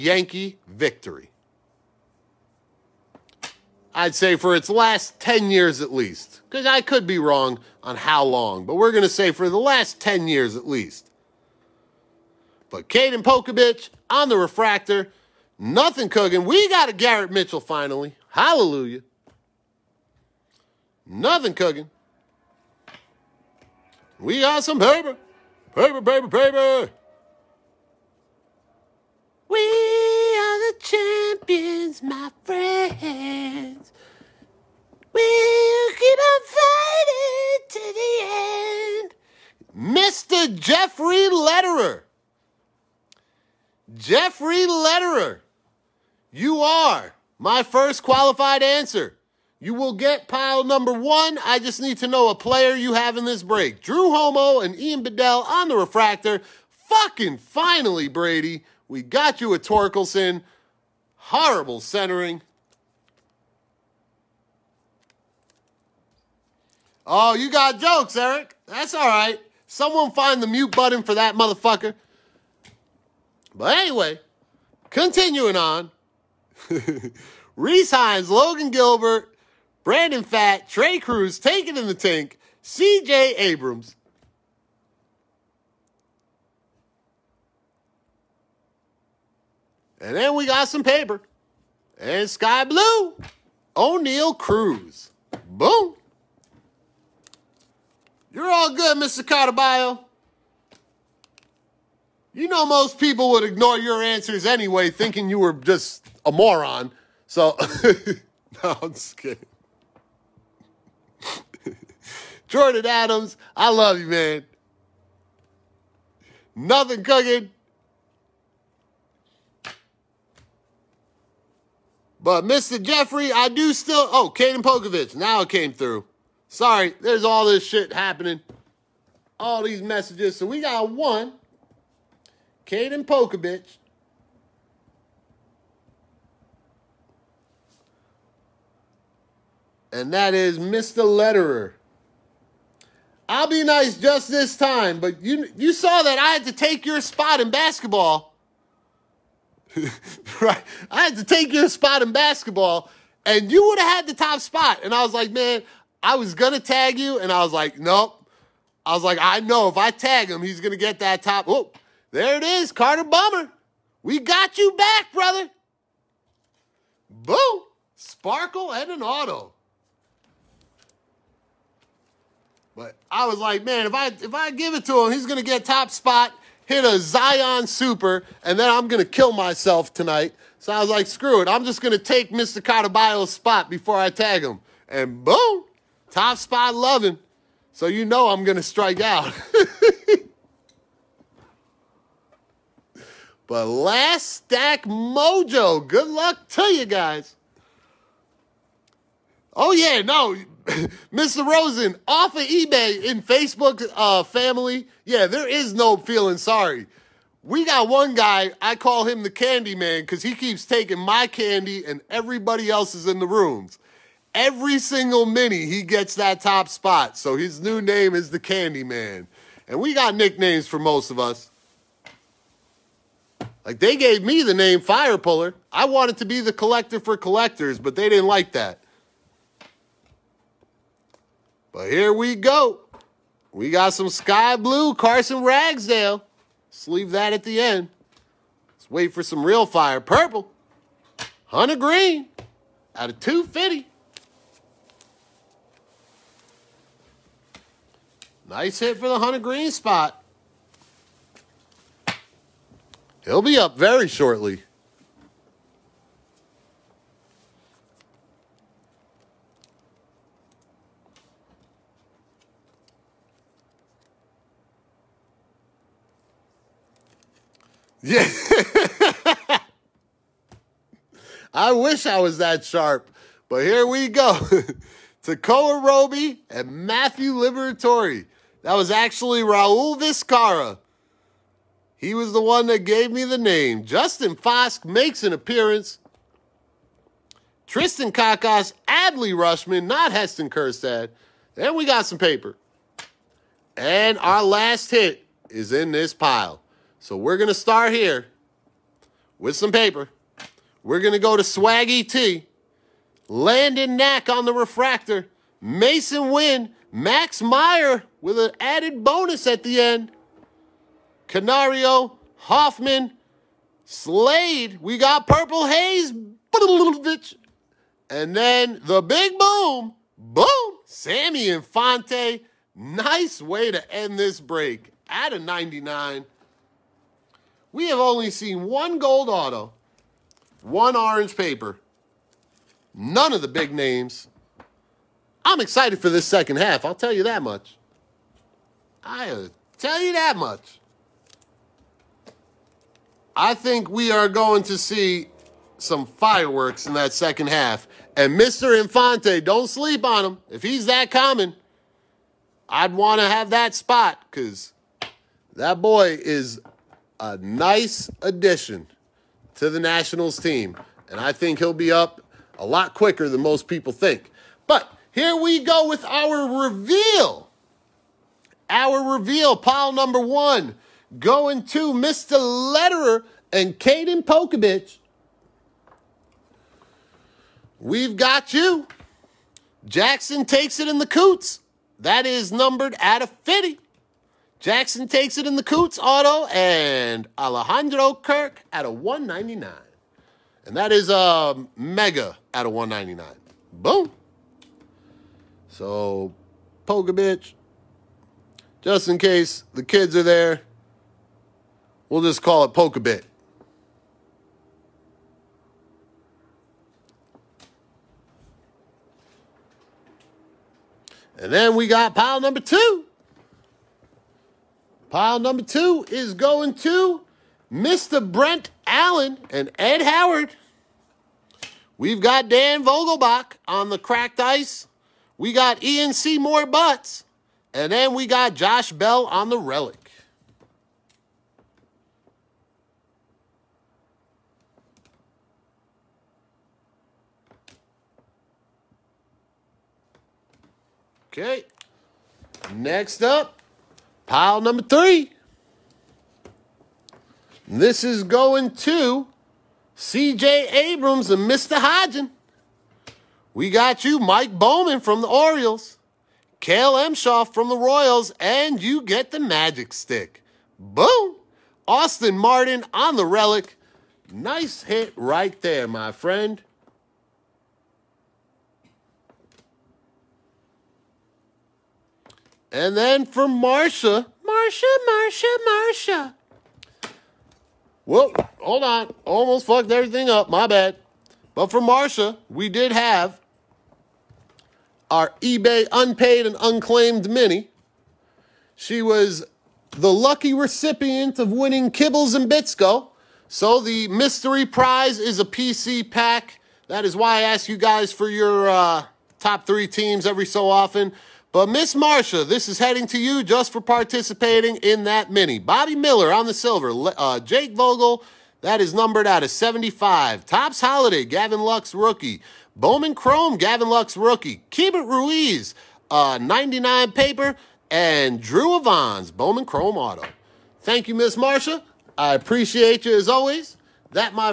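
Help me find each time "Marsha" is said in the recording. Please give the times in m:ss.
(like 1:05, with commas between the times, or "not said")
8:21, 8:41.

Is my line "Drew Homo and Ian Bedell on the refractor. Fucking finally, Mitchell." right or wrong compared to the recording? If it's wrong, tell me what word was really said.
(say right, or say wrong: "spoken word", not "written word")
wrong: "Brady", not "Mitchell".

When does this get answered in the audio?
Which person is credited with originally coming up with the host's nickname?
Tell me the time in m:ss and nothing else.
4:39.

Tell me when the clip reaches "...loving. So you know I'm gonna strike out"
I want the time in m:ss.
3:06.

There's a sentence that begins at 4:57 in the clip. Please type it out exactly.
So we're going to start here with some paper.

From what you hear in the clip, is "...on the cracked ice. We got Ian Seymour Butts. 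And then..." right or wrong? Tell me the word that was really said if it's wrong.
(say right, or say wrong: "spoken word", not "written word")
right.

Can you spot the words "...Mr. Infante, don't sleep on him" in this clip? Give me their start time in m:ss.
5:48.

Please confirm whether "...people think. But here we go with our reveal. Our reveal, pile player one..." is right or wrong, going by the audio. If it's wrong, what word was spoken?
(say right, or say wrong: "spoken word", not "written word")
wrong: "number", not "player".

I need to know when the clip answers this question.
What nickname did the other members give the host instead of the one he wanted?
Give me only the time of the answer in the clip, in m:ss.
3:44.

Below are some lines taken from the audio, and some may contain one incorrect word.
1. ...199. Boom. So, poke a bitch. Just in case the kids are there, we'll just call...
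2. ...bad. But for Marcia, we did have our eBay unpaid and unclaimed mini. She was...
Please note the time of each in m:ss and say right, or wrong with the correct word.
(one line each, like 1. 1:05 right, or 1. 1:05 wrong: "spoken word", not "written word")
1. 6:32 right
2. 8:00 right.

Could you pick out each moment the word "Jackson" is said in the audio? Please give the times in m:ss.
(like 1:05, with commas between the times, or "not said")
6:19, 6:24.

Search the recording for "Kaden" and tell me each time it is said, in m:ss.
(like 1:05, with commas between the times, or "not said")
0:12, 2:04, 2:12, 6:13.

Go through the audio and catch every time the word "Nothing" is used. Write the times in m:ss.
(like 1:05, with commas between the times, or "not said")
0:15, 0:21, 1:56.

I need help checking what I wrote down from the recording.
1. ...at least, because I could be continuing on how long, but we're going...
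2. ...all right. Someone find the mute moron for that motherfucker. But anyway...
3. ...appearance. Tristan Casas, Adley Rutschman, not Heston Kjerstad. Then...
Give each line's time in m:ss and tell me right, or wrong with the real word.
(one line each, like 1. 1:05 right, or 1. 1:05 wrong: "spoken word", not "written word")
1. 0:05 wrong: "wrong", not "continuing"
2. 1:08 wrong: "button", not "moron"
3. 4:45 right.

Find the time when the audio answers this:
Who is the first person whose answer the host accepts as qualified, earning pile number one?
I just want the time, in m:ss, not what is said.
0:39.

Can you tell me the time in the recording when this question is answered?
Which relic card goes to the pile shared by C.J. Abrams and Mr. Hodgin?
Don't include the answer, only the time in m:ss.
7:41.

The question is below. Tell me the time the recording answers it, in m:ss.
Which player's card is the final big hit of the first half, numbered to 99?
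5:20.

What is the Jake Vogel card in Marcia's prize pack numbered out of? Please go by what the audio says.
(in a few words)
75.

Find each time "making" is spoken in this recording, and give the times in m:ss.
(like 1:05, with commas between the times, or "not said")
not said.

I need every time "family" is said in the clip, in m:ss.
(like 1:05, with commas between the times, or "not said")
3:24.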